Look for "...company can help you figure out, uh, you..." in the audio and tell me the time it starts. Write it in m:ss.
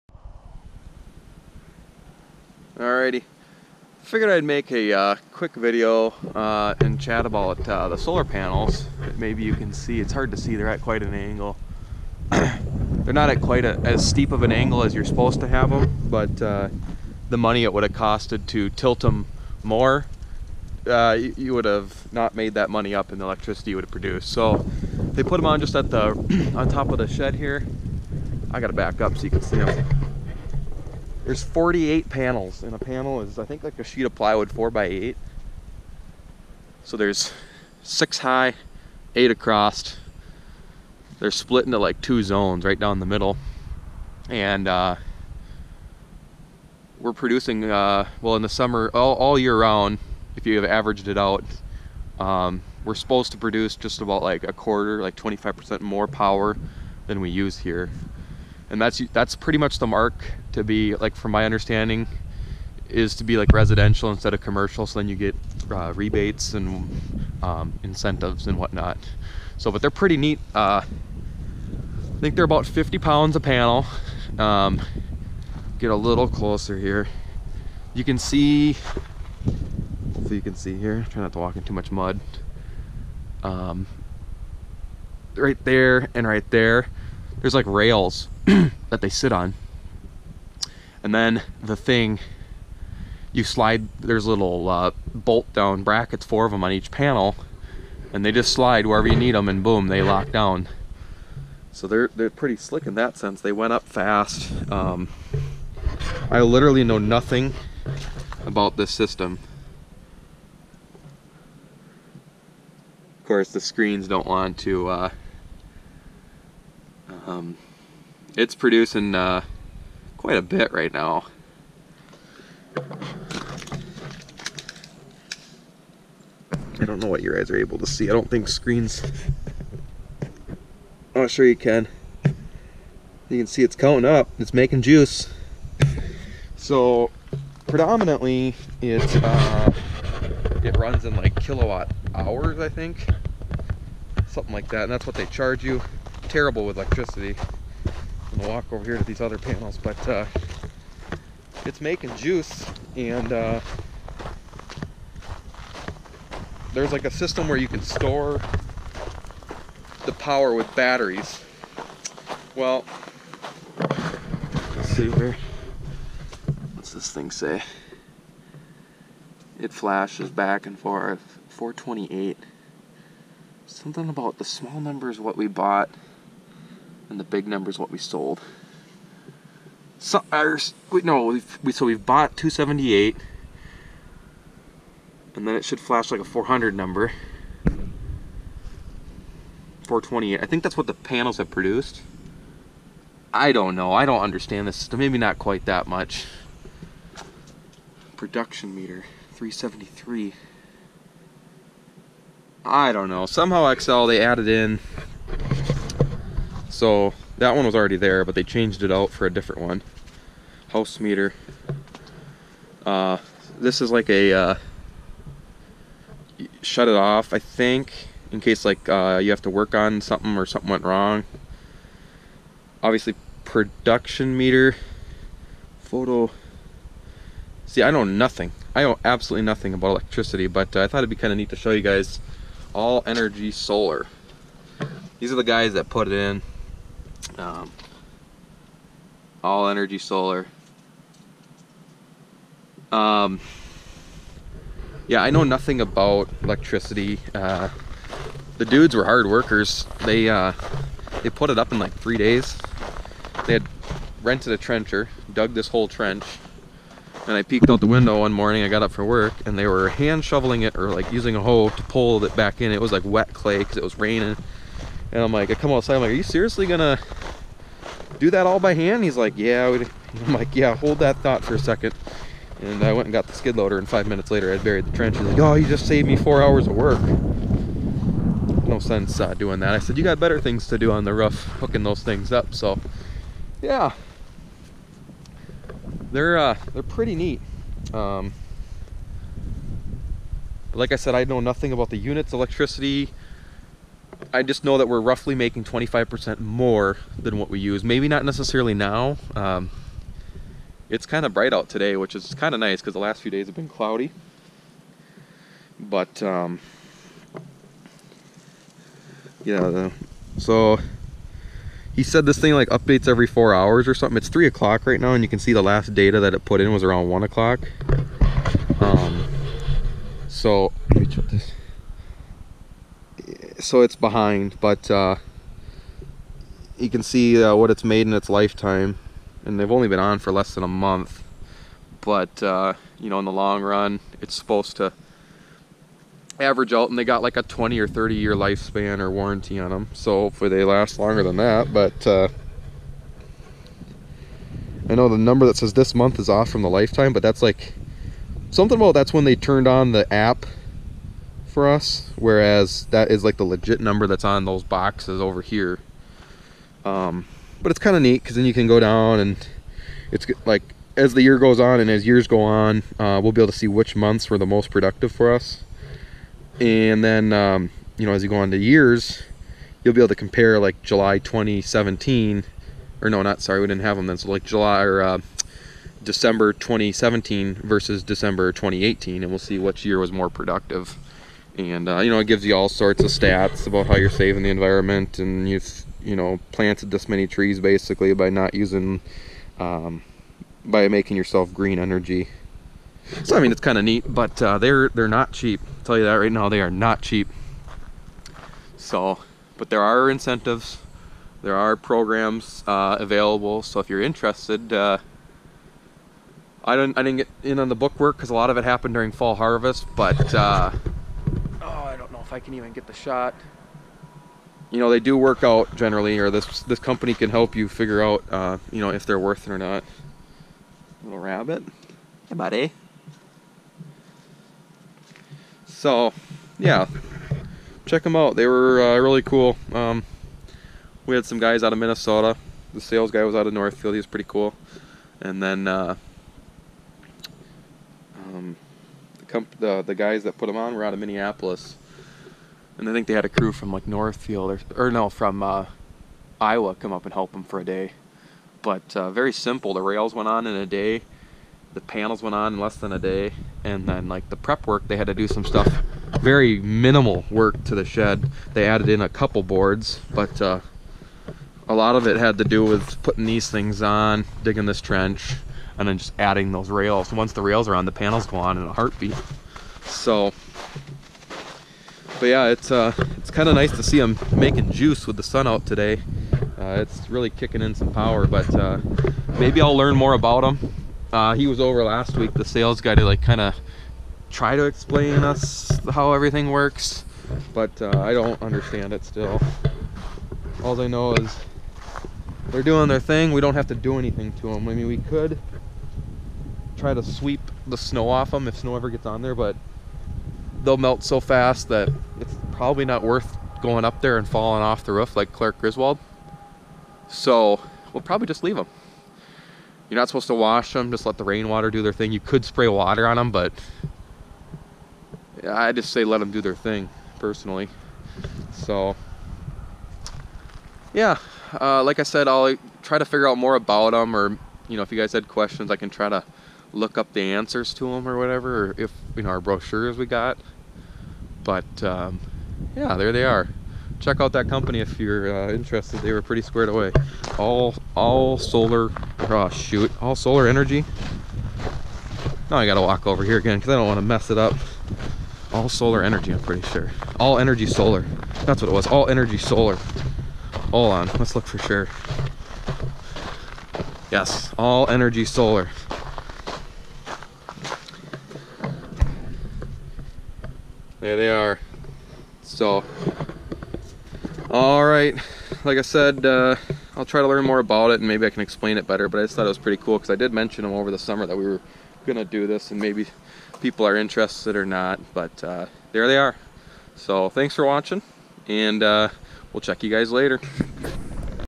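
6:56.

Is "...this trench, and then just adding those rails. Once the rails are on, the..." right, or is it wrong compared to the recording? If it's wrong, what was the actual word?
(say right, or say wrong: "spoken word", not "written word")
right.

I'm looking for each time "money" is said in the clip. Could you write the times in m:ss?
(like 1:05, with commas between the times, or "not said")
0:17, 0:22.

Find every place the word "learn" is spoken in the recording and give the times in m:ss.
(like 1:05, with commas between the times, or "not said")
7:59, 9:27.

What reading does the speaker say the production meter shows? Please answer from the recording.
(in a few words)
373.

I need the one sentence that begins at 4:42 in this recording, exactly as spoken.
So, yeah, they're uh, they're pretty neat.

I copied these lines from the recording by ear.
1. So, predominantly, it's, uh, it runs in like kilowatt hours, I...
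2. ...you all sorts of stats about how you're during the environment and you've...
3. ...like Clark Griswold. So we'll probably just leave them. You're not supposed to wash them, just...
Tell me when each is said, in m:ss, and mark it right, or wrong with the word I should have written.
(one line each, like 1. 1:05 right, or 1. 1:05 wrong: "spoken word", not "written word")
1. 2:16 right
2. 6:22 wrong: "saving", not "during"
3. 8:25 right.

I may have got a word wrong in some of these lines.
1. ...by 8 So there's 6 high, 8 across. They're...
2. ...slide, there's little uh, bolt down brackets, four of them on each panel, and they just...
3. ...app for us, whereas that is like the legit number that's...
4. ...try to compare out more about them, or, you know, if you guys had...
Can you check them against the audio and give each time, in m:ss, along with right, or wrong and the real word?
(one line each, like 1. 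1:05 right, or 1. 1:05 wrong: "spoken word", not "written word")
1. 0:34 right
2. 1:33 right
3. 5:50 right
4. 8:42 wrong: "figure", not "compare".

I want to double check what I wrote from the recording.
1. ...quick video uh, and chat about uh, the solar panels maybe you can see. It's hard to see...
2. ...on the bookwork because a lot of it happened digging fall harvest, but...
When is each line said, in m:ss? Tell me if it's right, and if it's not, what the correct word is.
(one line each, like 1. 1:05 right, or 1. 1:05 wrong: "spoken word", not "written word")
1. 0:05 right
2. 6:47 wrong: "during", not "digging".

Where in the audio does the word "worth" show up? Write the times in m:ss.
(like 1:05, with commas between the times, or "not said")
6:59, 8:23.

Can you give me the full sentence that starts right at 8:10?
All I know is they're doing their thing.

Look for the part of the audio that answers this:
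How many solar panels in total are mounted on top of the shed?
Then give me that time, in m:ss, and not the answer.
0:31.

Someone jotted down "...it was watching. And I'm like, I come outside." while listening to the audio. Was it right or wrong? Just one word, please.
wrong.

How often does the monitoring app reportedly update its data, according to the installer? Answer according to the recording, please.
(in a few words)
every 4 hours.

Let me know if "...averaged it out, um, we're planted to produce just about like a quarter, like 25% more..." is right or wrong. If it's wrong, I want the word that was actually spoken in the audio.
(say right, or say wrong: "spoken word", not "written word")
wrong: "supposed", not "planted".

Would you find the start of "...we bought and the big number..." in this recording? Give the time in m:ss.
2:55.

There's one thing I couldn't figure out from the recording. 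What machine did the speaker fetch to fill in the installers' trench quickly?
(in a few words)
skid loader.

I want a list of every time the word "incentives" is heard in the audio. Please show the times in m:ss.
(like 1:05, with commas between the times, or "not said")
1:07, 6:40.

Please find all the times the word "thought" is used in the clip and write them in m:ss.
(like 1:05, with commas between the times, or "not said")
3:50, 4:31, 9:29.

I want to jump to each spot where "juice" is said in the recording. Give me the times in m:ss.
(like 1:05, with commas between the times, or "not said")
2:14, 2:32, 7:54.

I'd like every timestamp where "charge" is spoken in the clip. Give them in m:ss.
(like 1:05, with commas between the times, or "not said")
2:25.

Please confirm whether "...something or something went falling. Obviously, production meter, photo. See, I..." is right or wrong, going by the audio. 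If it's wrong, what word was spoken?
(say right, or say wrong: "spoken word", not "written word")
wrong: "wrong", not "falling".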